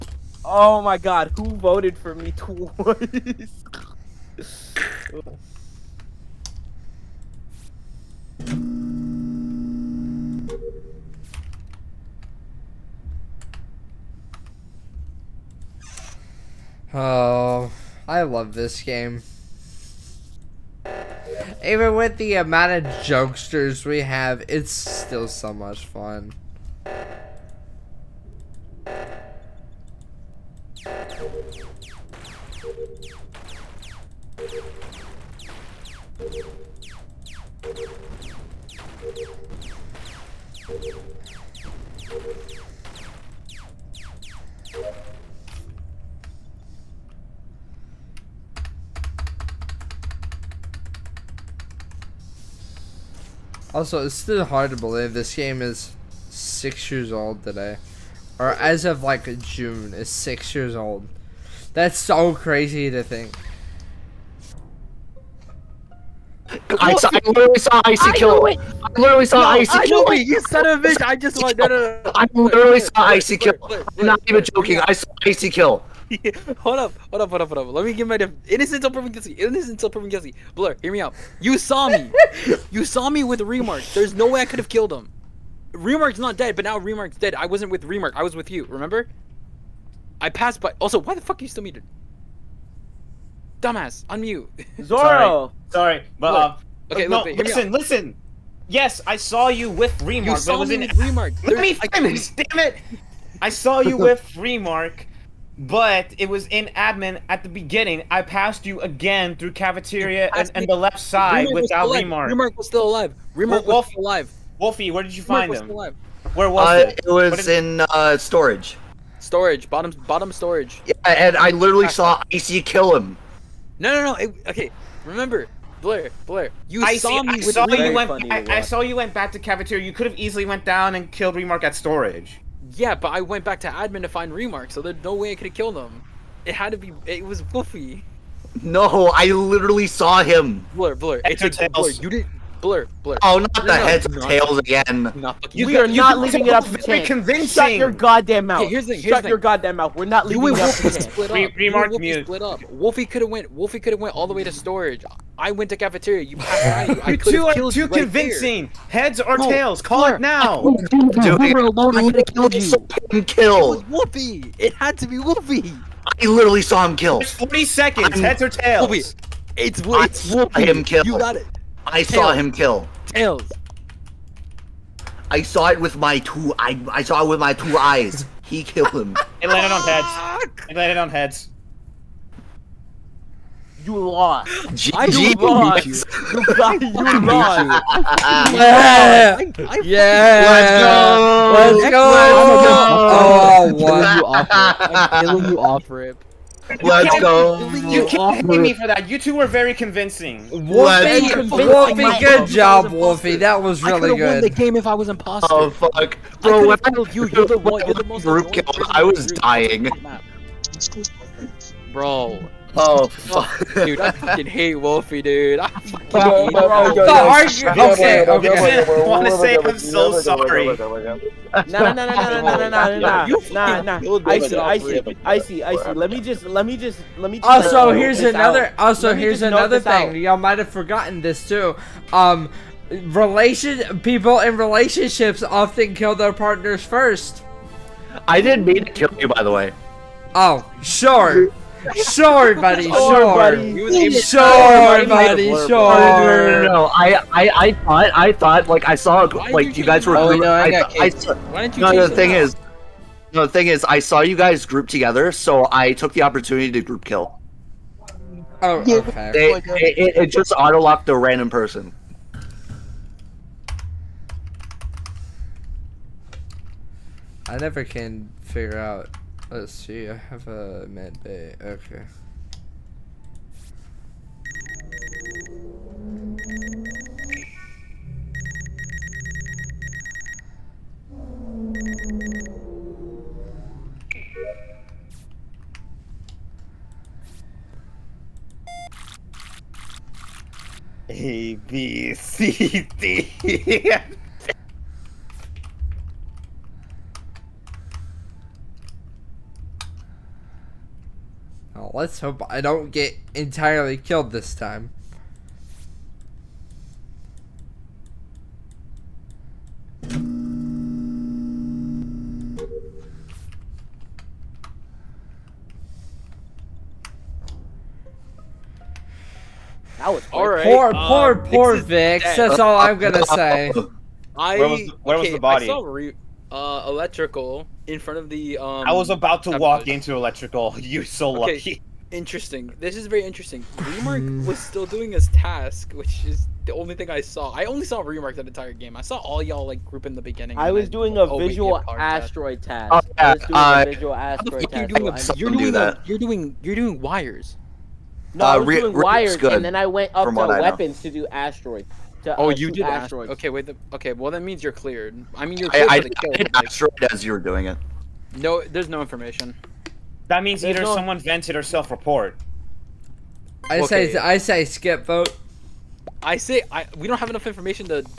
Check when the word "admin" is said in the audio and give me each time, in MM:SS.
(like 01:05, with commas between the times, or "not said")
01:46, 02:13.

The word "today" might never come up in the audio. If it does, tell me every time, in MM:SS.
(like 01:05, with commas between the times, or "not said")
00:57.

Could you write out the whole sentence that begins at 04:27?
I never can figure out Let's see, I have a med bay.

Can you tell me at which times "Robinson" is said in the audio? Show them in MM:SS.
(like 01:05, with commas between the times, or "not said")
not said.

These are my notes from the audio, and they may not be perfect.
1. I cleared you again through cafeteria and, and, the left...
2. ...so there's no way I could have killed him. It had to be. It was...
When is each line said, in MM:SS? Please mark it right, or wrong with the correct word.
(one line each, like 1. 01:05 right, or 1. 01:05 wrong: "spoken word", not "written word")
1. 01:48 wrong: "passed", not "cleared"
2. 02:14 right.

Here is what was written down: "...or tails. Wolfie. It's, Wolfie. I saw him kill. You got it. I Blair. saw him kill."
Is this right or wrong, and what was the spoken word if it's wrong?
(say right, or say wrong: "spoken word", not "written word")
wrong: "Tails", not "Blair".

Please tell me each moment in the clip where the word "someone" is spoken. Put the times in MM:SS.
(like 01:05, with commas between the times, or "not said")
06:00.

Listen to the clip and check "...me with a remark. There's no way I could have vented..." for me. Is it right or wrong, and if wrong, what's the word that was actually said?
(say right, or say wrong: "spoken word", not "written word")
wrong: "killed", not "vented".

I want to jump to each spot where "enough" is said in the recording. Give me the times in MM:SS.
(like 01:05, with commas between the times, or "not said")
06:07.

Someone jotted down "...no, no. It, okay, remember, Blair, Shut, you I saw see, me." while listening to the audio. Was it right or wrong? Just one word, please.
wrong.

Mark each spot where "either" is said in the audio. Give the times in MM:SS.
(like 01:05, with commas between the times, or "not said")
06:00.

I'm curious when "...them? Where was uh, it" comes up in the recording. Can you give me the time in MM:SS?
01:55.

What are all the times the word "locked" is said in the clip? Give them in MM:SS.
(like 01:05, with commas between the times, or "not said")
04:20.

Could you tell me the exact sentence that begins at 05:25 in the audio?
I saw re- uh, electrical in front of the.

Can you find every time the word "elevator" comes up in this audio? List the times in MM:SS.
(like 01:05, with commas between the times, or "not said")
not said.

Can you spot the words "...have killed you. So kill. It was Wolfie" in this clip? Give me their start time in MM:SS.
02:42.